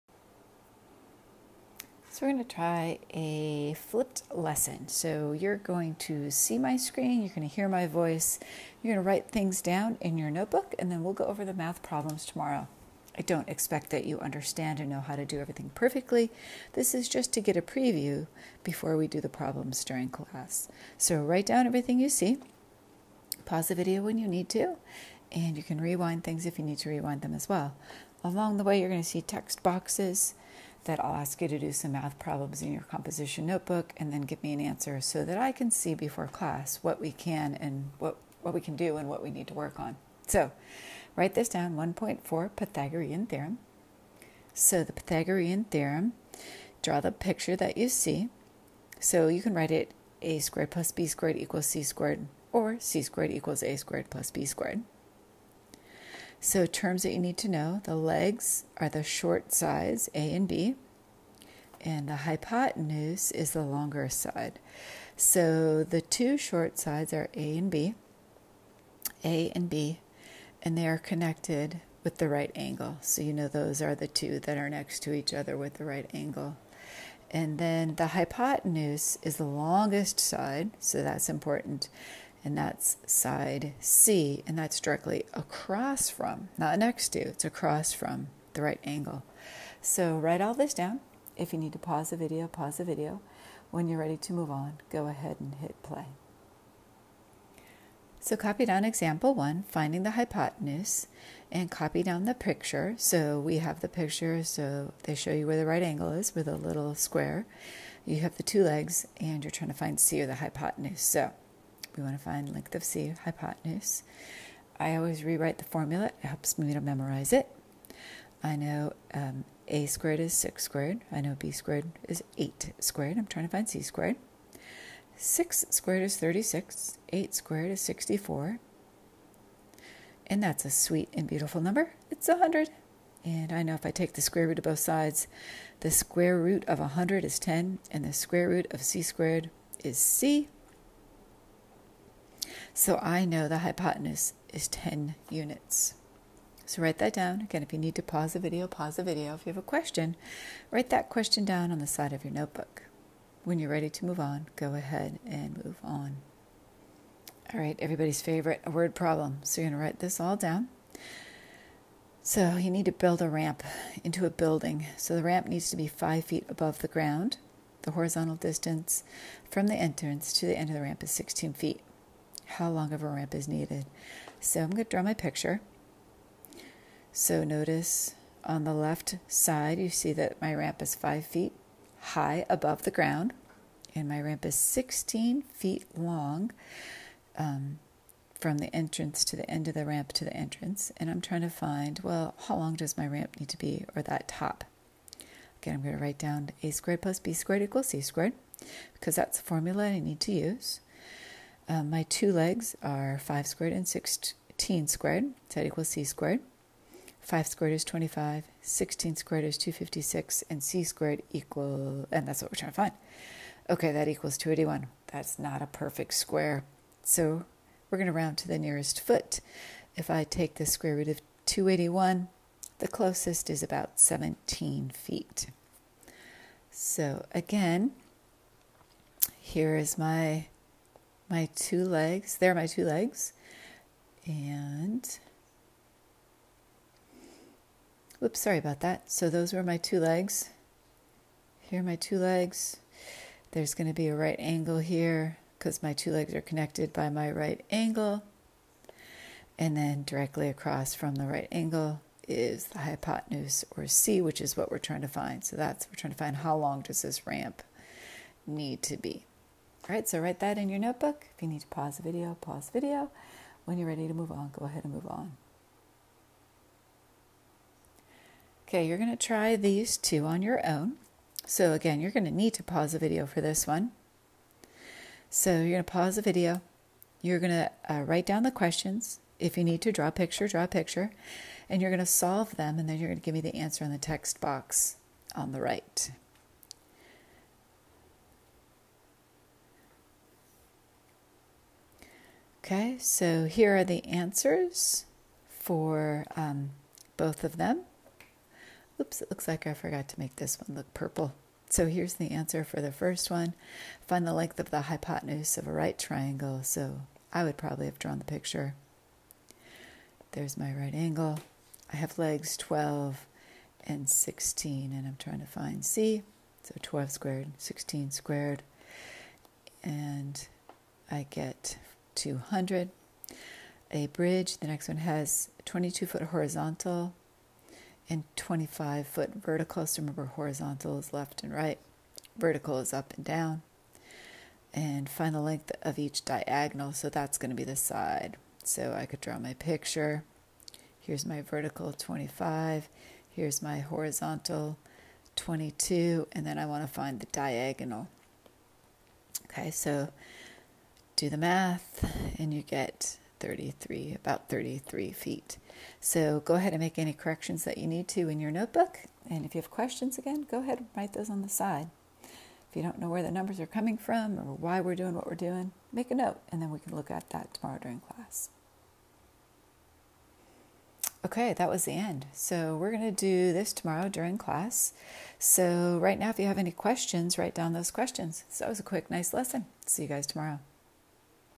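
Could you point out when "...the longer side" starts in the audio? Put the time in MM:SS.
01:03.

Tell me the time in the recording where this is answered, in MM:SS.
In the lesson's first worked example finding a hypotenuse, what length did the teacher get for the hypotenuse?
02:24.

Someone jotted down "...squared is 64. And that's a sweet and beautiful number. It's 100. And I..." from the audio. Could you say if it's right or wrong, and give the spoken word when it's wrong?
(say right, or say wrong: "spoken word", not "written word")
right.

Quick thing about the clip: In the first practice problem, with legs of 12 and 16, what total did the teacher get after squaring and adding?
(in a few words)
200.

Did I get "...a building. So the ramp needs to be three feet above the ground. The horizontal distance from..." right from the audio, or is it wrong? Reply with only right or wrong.
wrong.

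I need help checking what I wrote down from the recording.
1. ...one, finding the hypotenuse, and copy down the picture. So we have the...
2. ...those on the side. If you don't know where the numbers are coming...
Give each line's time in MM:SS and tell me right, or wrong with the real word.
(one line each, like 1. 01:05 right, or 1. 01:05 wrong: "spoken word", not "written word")
1. 01:39 right
2. 06:01 right.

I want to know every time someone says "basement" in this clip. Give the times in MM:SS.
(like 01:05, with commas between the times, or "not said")
not said.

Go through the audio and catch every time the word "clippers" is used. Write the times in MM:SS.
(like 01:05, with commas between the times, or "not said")
not said.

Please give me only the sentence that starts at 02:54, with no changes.
So I'm going to draw my picture.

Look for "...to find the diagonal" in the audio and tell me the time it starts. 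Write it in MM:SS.
05:46.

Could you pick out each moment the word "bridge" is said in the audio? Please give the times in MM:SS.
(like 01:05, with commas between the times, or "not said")
05:24.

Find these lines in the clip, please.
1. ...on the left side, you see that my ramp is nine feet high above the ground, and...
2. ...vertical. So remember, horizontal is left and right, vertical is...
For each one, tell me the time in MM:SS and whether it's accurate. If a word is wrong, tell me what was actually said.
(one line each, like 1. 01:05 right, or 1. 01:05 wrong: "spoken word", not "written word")
1. 02:58 wrong: "five", not "nine"
2. 05:29 right.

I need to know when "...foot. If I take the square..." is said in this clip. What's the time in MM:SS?
03:38.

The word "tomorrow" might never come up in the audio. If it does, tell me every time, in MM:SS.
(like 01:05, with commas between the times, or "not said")
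00:12, 06:07, 06:13, 06:20.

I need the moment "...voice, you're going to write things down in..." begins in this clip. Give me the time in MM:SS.
00:07.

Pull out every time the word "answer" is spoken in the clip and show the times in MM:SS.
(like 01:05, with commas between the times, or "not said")
00:34, 04:43, 04:54, 05:02.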